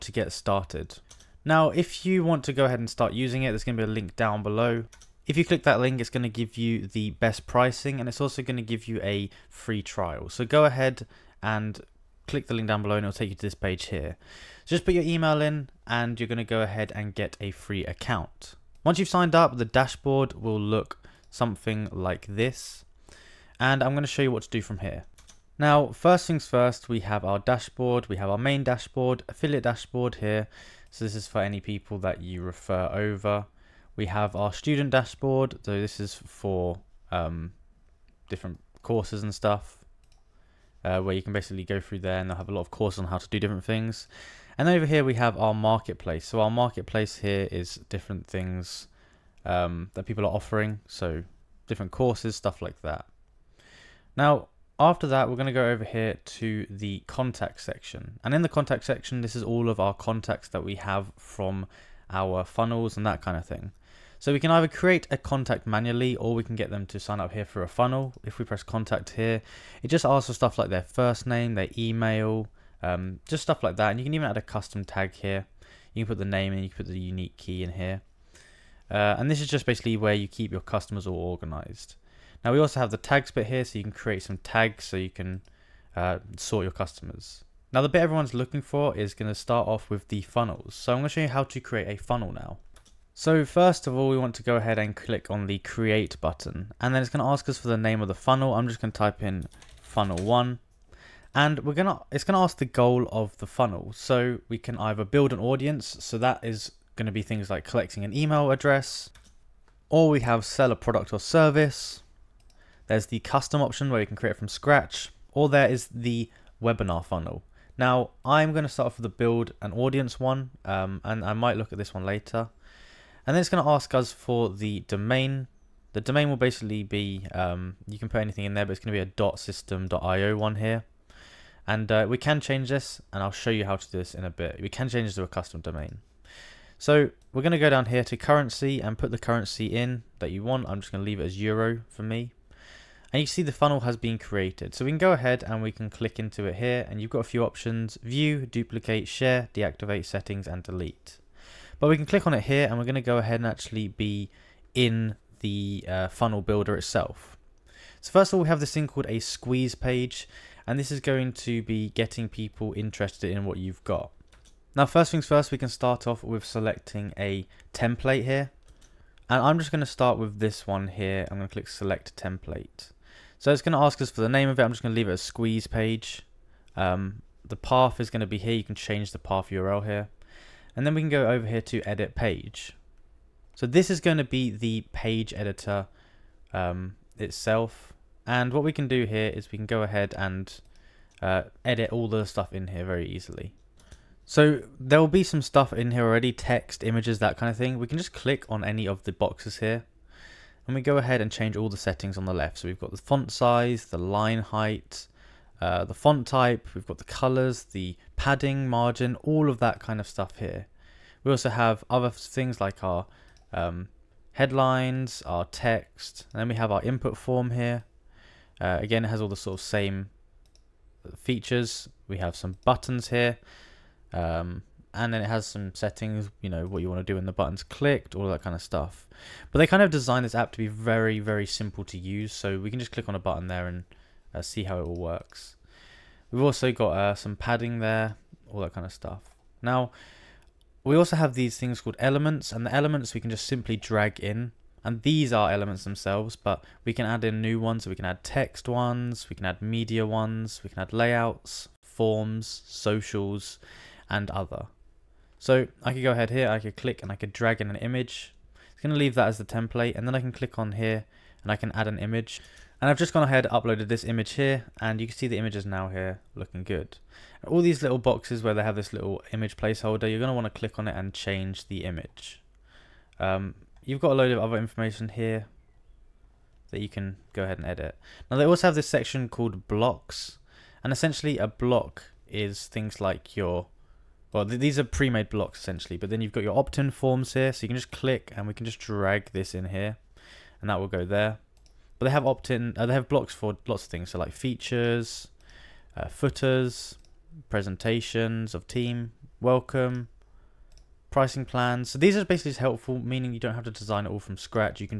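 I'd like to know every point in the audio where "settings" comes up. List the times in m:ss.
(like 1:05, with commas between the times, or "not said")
2:30, 3:21, 3:45.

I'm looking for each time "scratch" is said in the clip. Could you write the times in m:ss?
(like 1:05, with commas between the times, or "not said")
1:54, 5:04.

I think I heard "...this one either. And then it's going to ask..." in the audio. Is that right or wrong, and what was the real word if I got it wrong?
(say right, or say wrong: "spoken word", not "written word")
wrong: "later", not "either".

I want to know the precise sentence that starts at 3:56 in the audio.
We've also got uh, some padding there, all that kind of stuff.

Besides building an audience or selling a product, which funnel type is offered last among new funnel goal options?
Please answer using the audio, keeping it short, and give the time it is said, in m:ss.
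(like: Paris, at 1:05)
webinar funnel, at 1:56.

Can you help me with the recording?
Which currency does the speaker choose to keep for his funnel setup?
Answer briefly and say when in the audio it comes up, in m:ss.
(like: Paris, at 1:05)
euro, at 2:21.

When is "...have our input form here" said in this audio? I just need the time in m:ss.
3:36.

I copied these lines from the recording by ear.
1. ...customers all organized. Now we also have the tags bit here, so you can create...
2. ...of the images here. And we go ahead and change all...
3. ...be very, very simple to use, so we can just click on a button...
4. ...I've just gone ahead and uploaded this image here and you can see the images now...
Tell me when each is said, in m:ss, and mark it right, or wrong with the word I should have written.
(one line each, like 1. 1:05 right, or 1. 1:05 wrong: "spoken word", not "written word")
1. 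1:20 right
2. 3:18 wrong: "boxes", not "images"
3. 3:50 right
4. 4:22 right.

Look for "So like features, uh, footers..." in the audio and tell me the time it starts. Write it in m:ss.
4:54.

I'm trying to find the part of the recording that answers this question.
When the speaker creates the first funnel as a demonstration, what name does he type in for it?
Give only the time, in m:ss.
1:39.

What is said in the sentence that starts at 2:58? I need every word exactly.
You can change the path URL here.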